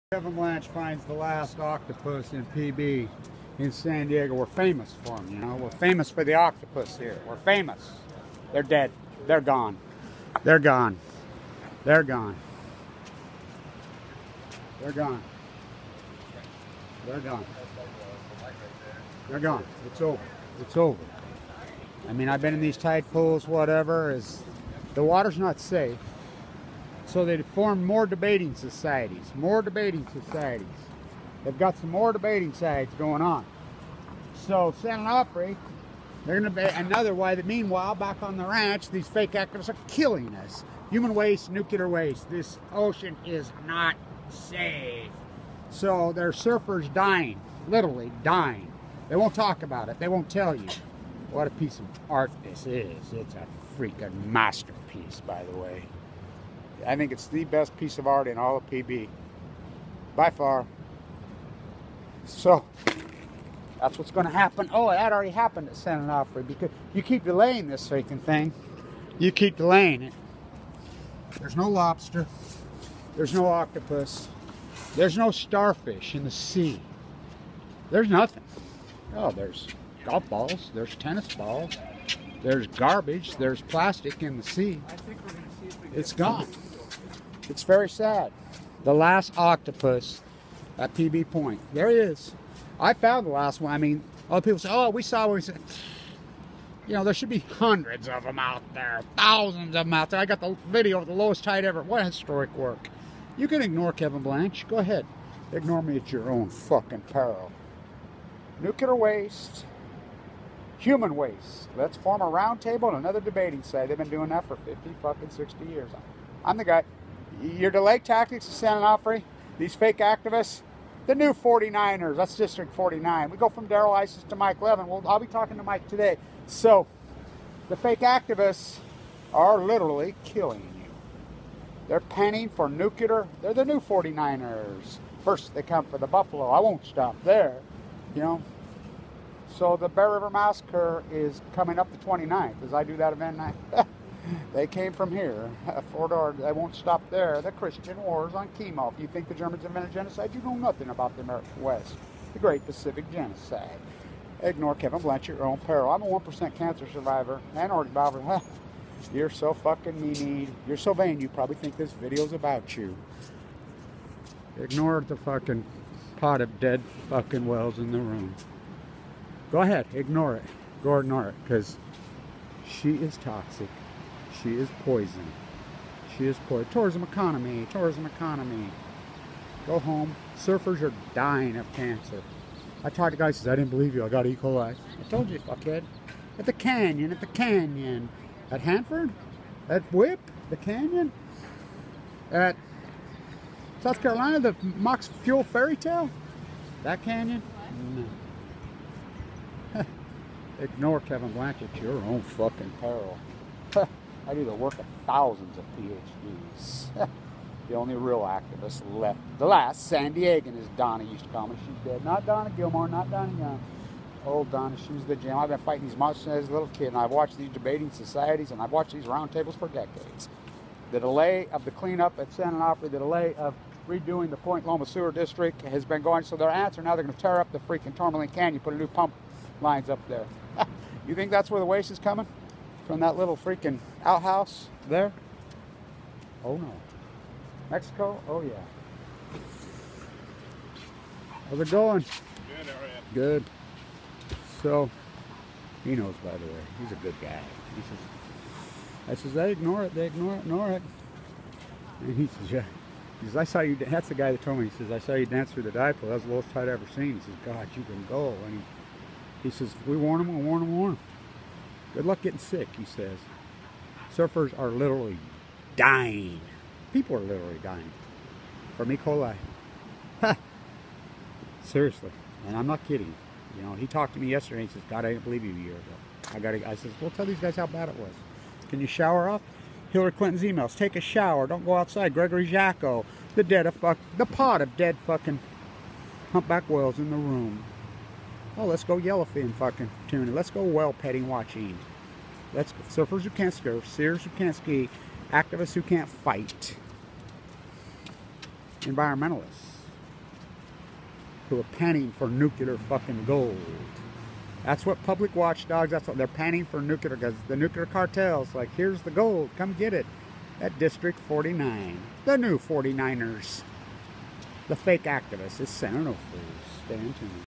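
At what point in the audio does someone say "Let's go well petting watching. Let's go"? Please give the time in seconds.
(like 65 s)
290 s.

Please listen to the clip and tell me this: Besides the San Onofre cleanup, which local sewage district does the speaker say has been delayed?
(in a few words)
Point Loma Sewer District.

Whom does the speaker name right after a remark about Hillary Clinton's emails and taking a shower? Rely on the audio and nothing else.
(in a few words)
Gregory Jaczko.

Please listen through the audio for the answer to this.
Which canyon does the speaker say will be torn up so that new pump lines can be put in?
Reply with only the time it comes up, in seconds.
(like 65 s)
227 s.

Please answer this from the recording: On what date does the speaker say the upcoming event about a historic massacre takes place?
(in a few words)
29th.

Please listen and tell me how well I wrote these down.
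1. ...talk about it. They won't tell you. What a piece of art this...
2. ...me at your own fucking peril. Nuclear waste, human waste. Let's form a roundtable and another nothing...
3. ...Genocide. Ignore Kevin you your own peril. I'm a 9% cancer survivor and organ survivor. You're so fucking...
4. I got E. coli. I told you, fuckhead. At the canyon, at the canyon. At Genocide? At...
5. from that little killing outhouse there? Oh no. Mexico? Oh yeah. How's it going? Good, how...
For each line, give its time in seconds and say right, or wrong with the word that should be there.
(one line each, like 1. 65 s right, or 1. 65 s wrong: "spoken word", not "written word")
1. 49 s right
2. 105 s wrong: "debating", not "nothing"
3. 153 s wrong: "1", not "9"
4. 184 s wrong: "Hanford", not "Genocide"
5. 232 s wrong: "freaking", not "killing".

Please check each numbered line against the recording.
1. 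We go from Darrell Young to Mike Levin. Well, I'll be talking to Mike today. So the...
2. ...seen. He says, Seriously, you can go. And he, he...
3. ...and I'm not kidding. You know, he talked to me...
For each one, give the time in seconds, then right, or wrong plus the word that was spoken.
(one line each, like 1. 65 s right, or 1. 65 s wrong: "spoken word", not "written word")
1. 123 s wrong: "Issa", not "Young"
2. 256 s wrong: "God", not "Seriously"
3. 272 s right.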